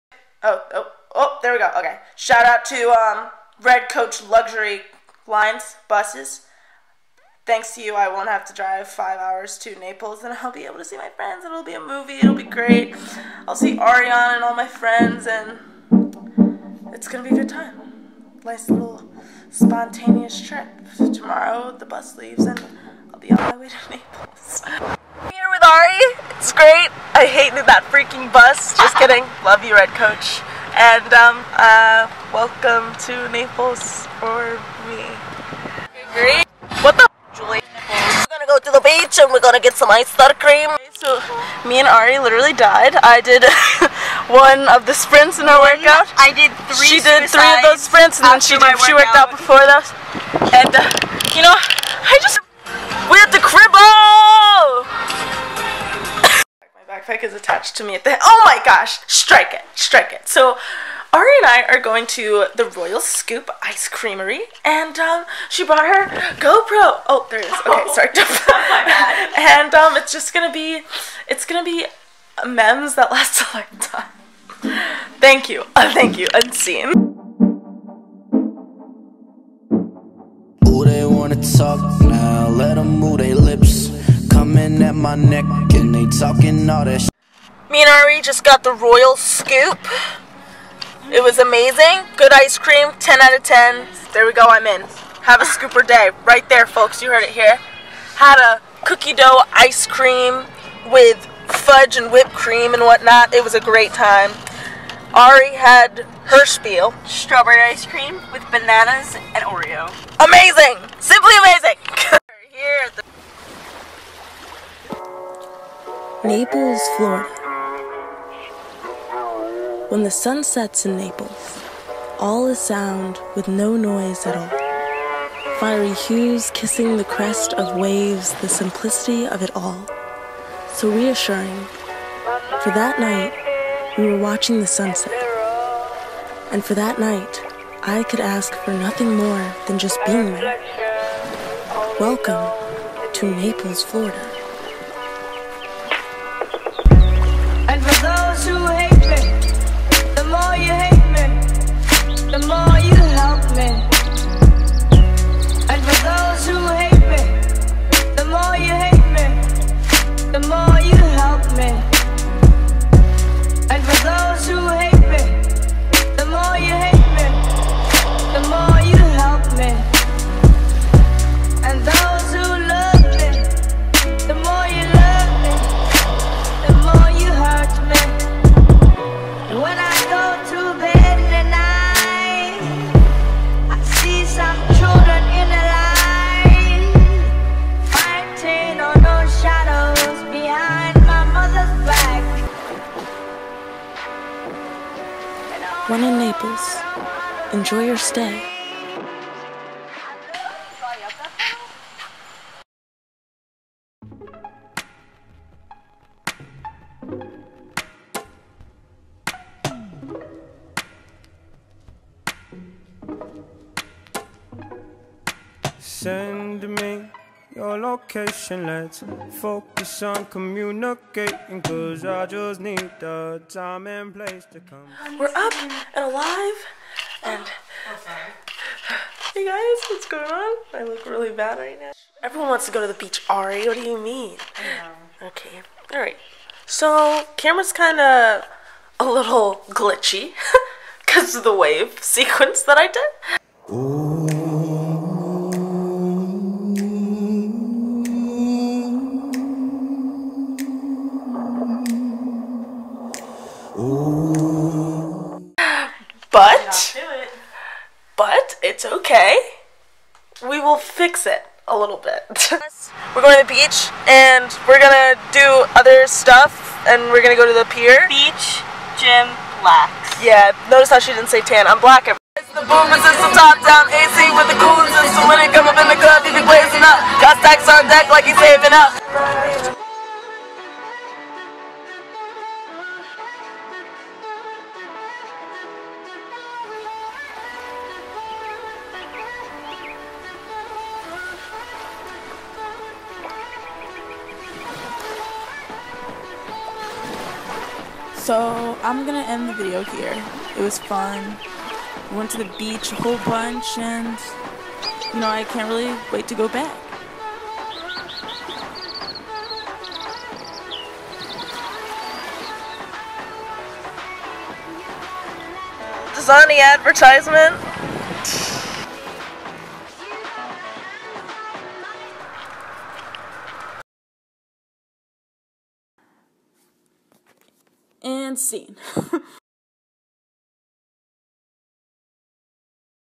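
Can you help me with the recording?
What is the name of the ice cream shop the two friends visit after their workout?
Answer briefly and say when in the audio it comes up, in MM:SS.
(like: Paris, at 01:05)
Royal Scoop Ice Creamery, at 01:02.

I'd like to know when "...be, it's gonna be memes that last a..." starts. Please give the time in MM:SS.
01:10.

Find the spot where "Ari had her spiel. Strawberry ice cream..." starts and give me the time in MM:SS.
01:45.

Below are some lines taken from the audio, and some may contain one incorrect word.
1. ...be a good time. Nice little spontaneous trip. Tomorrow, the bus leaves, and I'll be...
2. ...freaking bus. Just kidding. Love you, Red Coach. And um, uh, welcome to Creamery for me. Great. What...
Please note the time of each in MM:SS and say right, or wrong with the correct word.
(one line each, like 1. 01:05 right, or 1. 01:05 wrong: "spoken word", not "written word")
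1. 00:17 right
2. 00:27 wrong: "Naples", not "Creamery".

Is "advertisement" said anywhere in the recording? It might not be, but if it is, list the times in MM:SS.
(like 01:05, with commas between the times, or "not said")
05:16.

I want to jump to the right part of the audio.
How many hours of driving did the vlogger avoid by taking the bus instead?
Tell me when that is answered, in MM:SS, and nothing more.
00:08.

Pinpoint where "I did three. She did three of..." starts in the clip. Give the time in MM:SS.
00:46.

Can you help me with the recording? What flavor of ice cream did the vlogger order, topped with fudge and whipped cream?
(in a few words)
Cookie dough.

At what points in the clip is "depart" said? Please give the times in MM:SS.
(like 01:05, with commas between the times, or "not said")
not said.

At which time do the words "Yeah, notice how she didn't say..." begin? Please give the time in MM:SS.
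04:30.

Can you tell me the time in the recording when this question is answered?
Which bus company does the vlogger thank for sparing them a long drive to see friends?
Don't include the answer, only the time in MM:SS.
00:03.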